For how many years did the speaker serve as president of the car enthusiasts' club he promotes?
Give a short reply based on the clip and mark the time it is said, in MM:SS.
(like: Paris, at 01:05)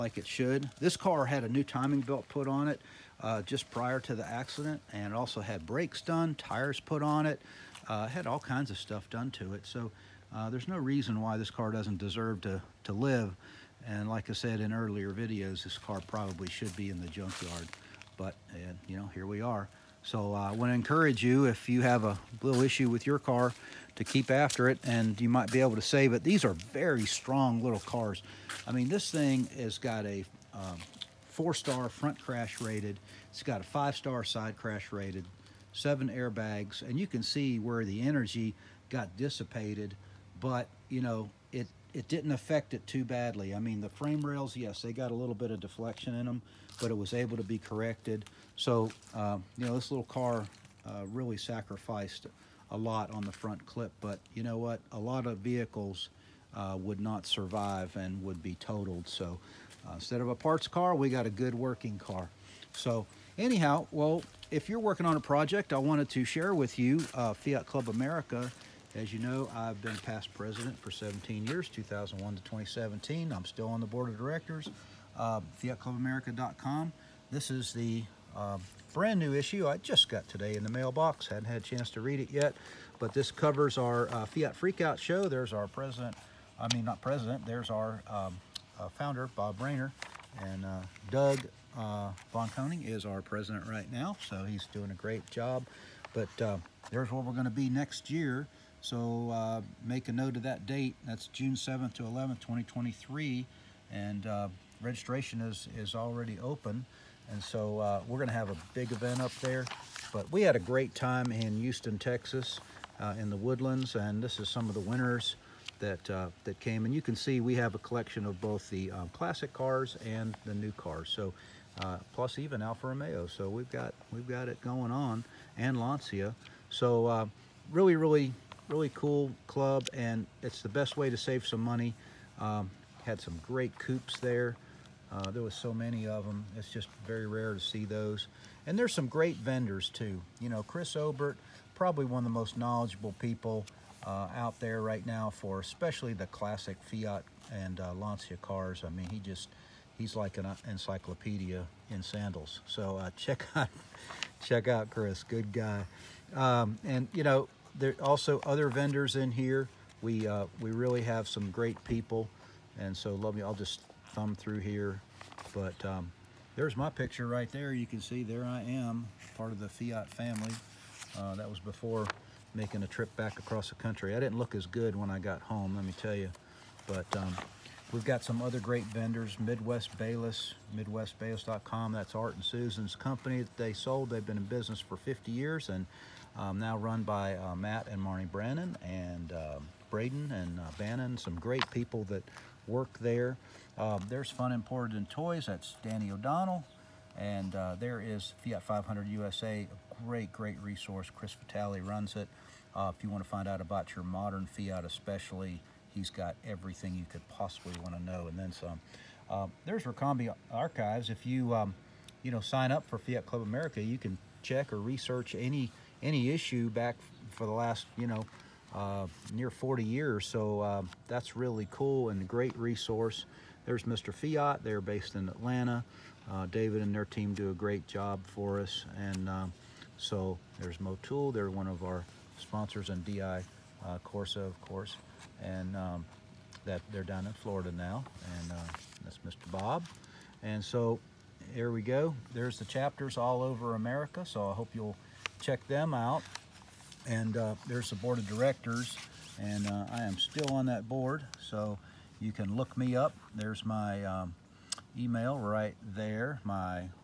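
17, at 01:10.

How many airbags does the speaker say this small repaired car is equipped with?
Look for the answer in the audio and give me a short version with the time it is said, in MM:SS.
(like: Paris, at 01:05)
7, at 00:35.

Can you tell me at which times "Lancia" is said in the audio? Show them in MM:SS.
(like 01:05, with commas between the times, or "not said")
02:05, 02:27.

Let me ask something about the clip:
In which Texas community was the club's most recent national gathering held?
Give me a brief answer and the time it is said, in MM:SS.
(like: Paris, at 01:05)
The Woodlands, at 01:53.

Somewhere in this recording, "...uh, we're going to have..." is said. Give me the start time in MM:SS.
01:47.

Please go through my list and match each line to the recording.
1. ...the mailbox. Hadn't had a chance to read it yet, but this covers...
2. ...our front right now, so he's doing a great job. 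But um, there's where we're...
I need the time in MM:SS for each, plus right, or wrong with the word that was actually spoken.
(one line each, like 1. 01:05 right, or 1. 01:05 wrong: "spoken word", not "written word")
1. 01:20 right
2. 01:33 wrong: "president", not "front".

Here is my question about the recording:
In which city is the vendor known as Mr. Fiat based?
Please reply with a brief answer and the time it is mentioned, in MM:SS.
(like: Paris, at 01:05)
Atlanta, at 03:45.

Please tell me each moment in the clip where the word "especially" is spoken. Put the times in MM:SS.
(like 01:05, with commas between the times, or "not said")
02:25, 03:24.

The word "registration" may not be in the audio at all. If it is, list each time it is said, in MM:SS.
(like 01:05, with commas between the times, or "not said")
01:44.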